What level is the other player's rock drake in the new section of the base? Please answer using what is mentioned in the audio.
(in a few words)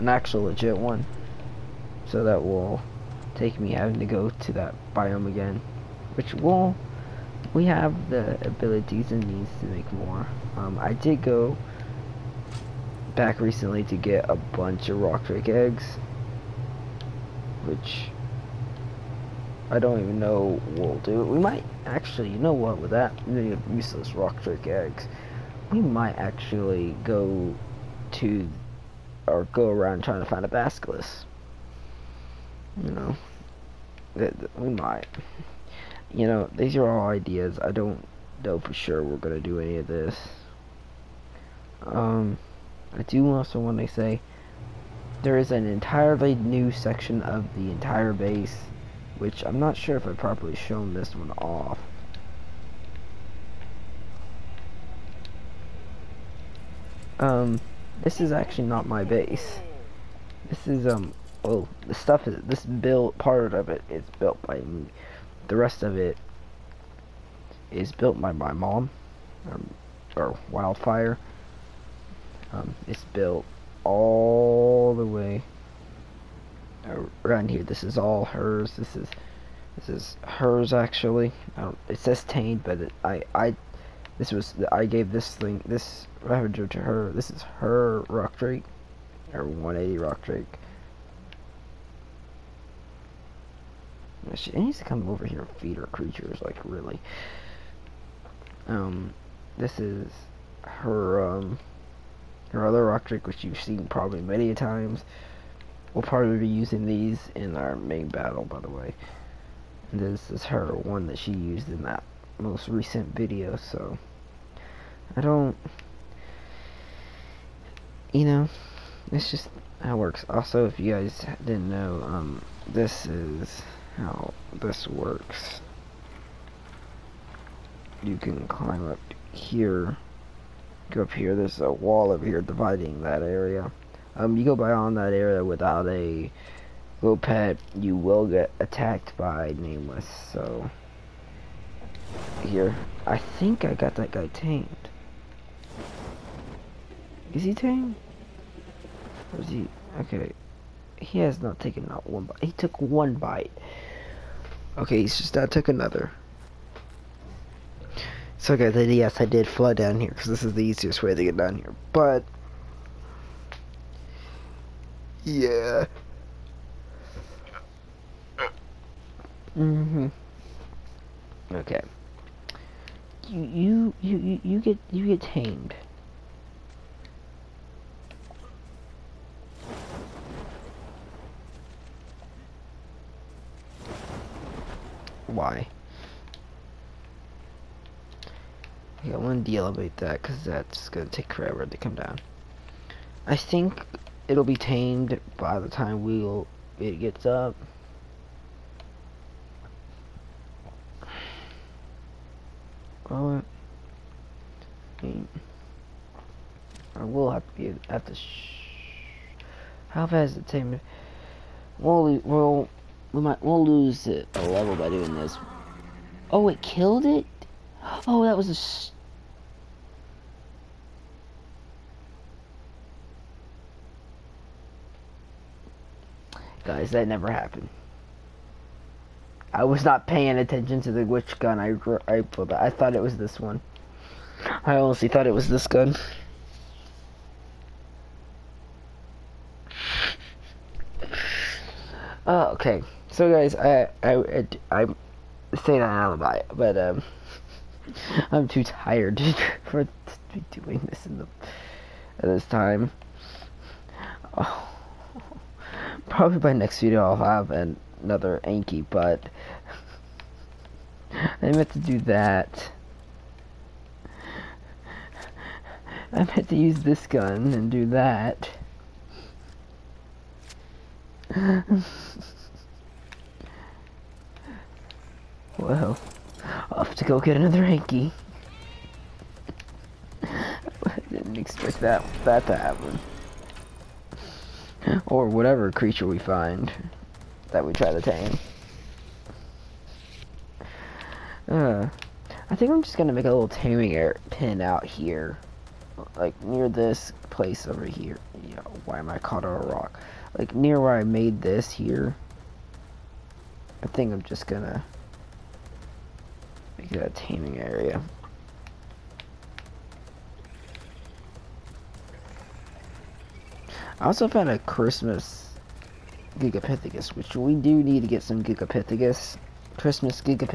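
180.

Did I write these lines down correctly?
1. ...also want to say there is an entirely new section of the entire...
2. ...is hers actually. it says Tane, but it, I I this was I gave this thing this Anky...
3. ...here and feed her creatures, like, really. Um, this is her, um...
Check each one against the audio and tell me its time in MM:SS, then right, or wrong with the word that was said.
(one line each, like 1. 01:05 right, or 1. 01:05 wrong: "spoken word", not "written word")
1. 00:43 right
2. 01:19 wrong: "Ravager", not "Anky"
3. 01:35 right.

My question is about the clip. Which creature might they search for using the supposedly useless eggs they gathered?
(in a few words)
Basilisk.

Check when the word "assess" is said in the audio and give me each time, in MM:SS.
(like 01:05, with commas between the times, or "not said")
not said.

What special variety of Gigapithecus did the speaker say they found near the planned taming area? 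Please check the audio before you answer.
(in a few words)
Christmas Gigapithecus.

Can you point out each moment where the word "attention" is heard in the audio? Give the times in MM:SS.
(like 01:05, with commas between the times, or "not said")
03:50.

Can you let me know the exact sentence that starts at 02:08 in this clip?
You can climb up here, go up here, there's a wall over here dividing that area.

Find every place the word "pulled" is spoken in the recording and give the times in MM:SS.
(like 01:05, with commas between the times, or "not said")
03:52.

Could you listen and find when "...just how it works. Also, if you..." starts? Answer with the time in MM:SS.
01:59.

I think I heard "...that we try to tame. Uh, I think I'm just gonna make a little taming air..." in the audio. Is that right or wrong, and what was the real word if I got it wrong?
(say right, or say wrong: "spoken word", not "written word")
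right.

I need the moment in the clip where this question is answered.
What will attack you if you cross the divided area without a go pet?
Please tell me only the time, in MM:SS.
02:19.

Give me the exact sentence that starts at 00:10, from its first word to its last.
Um, I did go back recently to get a bunch of rock drake eggs, which I don't even know we'll do.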